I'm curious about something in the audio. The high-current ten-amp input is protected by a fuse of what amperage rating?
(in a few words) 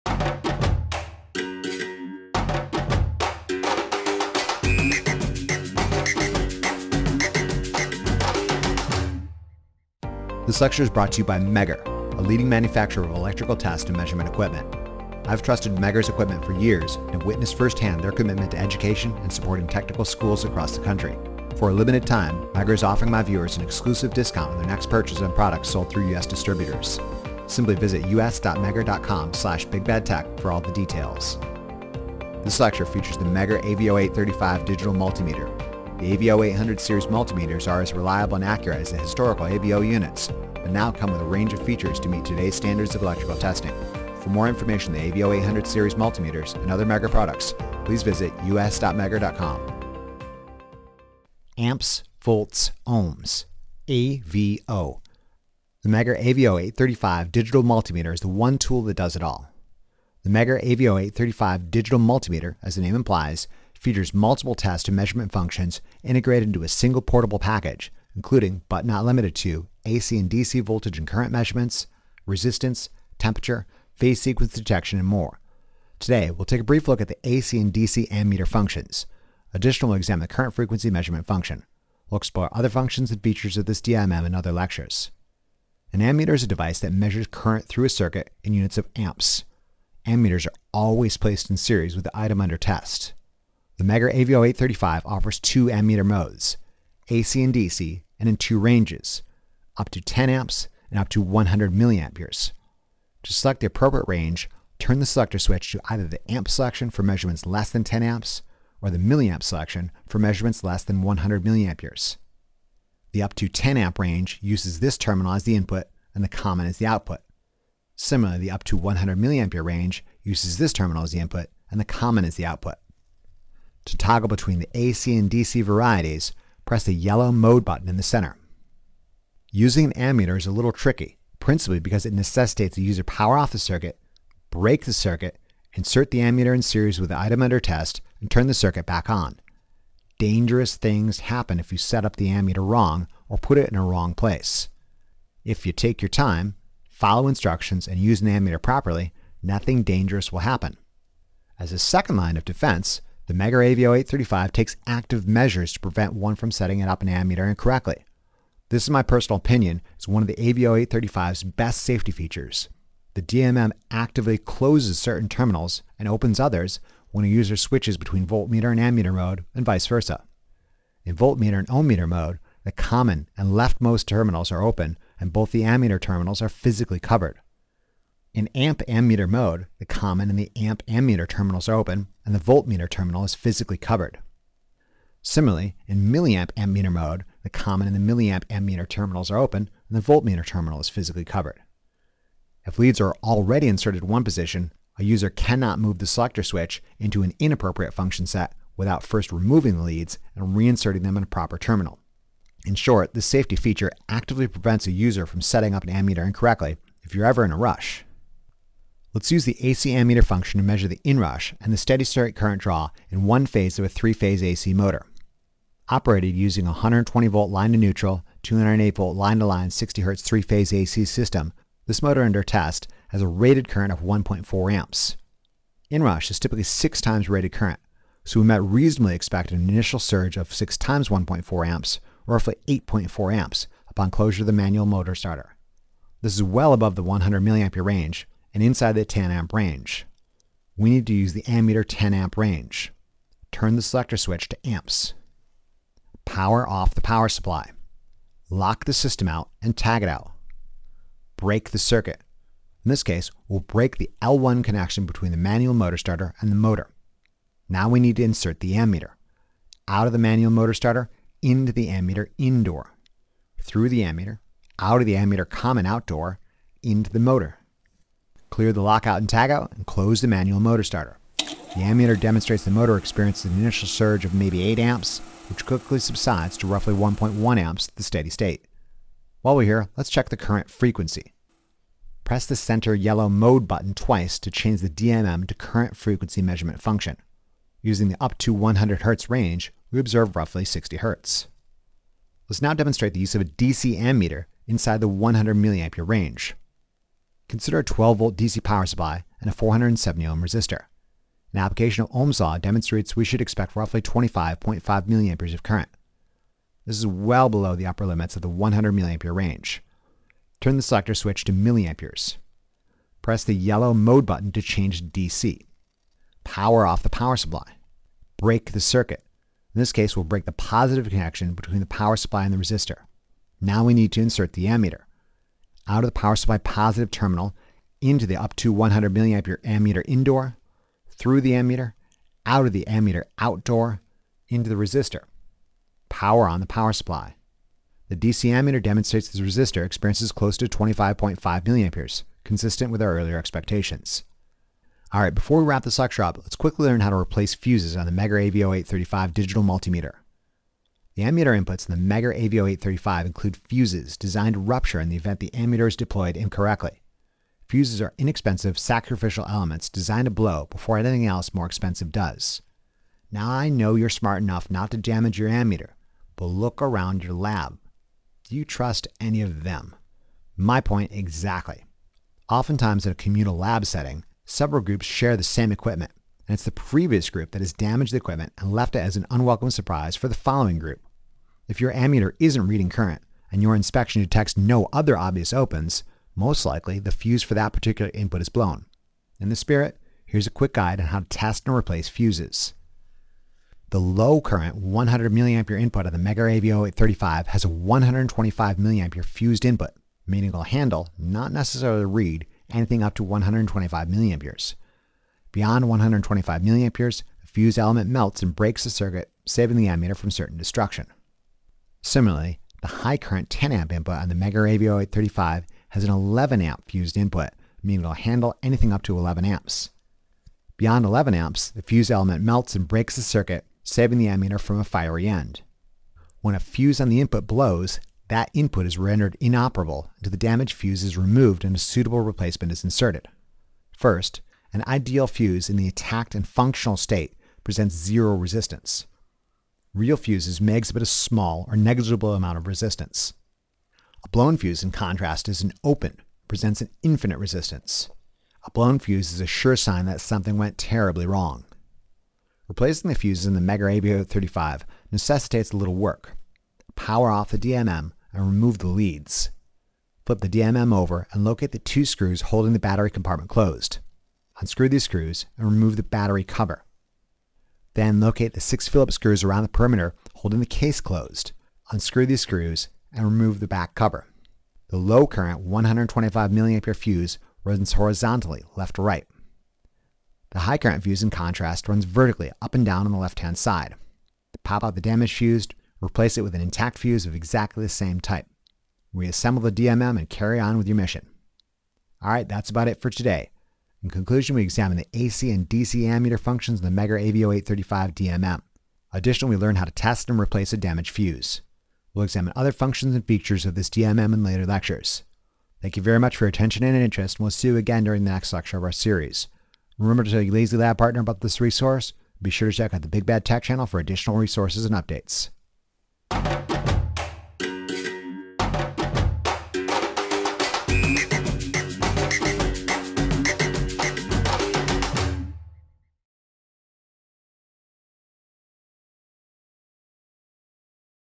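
11 amps.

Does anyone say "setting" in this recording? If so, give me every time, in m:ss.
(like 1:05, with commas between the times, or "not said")
2:36, 3:25, 6:13.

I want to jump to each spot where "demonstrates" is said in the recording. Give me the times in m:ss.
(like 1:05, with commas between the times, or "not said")
4:32, 4:52, 5:02, 5:38.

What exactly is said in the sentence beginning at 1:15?
Today, we'll take a brief look at the AC and DC ammeter functions.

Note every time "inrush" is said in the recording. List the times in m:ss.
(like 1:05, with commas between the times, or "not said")
3:31, 3:45.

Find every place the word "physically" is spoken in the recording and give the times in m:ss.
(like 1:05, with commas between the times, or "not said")
2:56, 3:03, 3:10.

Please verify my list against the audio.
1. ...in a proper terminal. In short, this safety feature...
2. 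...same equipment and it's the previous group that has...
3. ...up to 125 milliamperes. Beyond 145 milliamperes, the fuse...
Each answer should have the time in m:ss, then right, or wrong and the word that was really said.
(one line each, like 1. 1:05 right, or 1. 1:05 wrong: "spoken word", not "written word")
1. 3:21 right
2. 6:15 right
3. 6:43 wrong: "125", not "145".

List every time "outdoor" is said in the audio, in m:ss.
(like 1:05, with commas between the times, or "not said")
4:25, 5:33.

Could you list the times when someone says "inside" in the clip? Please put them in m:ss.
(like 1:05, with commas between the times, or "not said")
3:58, 4:54.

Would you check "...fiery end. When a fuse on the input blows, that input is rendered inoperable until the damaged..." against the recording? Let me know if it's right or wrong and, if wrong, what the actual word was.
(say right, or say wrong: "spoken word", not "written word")
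right.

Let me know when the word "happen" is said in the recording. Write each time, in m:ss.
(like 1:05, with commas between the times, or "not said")
2:21, 2:30.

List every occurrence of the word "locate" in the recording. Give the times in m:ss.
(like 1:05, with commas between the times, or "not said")
7:41, 7:48.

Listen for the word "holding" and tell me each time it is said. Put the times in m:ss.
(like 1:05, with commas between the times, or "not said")
7:42, 7:50.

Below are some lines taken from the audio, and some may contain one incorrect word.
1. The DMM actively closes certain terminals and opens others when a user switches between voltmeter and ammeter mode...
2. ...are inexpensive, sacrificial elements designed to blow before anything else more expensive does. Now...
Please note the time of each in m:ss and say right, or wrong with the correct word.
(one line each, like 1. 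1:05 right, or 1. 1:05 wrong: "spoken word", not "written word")
1. 2:43 right
2. 5:58 right.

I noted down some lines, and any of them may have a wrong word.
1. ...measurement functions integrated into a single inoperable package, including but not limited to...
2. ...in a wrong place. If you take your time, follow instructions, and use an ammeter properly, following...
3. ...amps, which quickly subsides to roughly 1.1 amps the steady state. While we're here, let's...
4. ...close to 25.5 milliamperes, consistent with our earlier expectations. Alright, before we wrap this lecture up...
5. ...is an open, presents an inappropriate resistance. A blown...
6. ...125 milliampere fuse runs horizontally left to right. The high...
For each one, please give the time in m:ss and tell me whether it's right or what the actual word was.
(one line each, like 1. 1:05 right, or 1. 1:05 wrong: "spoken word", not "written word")
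1. 1:04 wrong: "portable", not "inoperable"
2. 2:23 wrong: "nothing", not "following"
3. 4:34 right
4. 5:40 right
5. 7:25 wrong: "infinite", not "inappropriate"
6. 7:55 right.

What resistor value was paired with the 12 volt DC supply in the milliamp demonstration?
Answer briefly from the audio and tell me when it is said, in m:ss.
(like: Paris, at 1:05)
470 ohm, at 4:59.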